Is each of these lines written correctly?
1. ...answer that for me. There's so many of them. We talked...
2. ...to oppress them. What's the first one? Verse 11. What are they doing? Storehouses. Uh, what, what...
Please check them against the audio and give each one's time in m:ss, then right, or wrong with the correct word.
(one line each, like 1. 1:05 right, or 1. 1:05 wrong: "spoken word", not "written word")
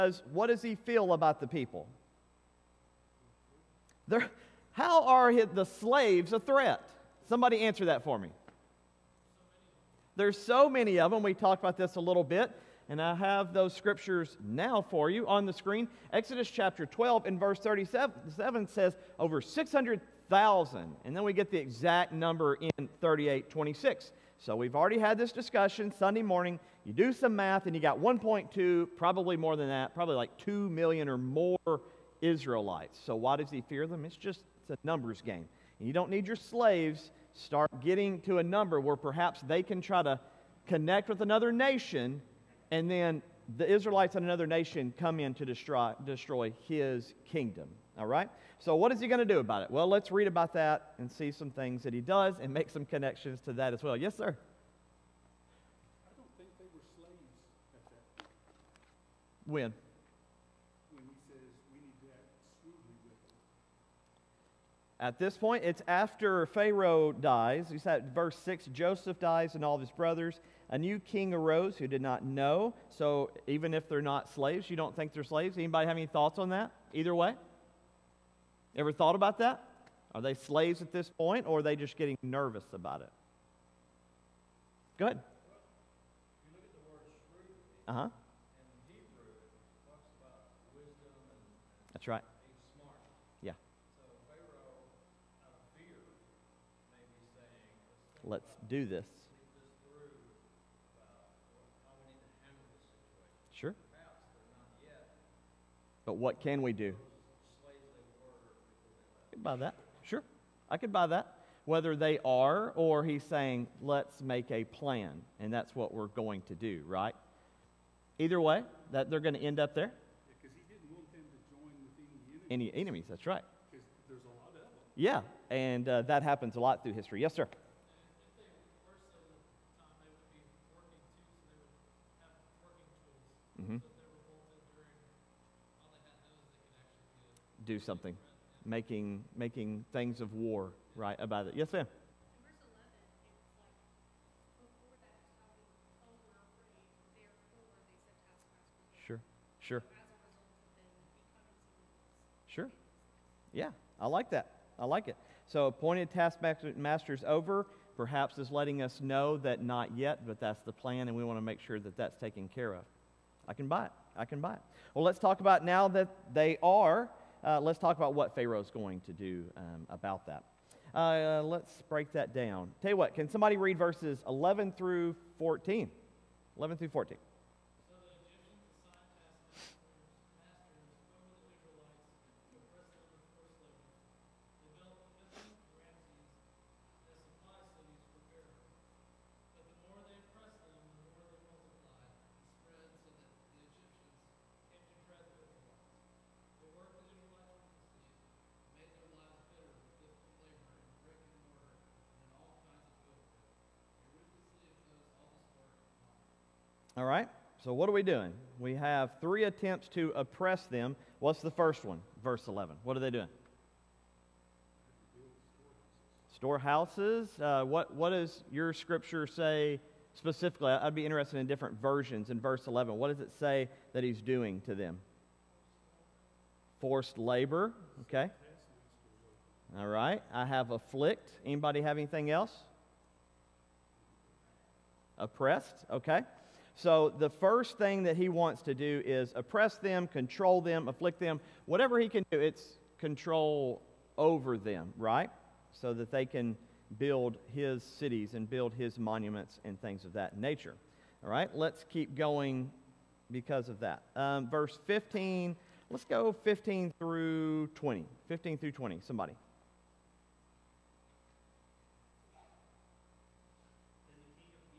1. 0:07 right
2. 3:29 right.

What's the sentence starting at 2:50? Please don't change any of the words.
Uh, uh, let's break that down.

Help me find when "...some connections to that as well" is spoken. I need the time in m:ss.
0:52.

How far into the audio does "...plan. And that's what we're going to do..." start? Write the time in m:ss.
1:54.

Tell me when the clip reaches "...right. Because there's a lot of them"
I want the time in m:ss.
2:03.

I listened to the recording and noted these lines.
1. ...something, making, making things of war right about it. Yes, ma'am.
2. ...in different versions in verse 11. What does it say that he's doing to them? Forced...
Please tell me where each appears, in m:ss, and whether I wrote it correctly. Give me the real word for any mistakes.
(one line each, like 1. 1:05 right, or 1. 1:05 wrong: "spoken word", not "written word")
1. 2:17 right
2. 3:41 right.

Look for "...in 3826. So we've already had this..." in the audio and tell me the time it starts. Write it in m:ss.
0:22.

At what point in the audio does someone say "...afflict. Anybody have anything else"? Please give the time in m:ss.
3:50.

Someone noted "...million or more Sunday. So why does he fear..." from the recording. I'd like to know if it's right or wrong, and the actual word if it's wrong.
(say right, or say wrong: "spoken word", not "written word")
wrong: "Israelites", not "Sunday".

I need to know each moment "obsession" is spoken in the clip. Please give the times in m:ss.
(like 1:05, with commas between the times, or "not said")
not said.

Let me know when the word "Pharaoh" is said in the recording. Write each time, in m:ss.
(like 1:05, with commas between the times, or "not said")
1:06, 2:48.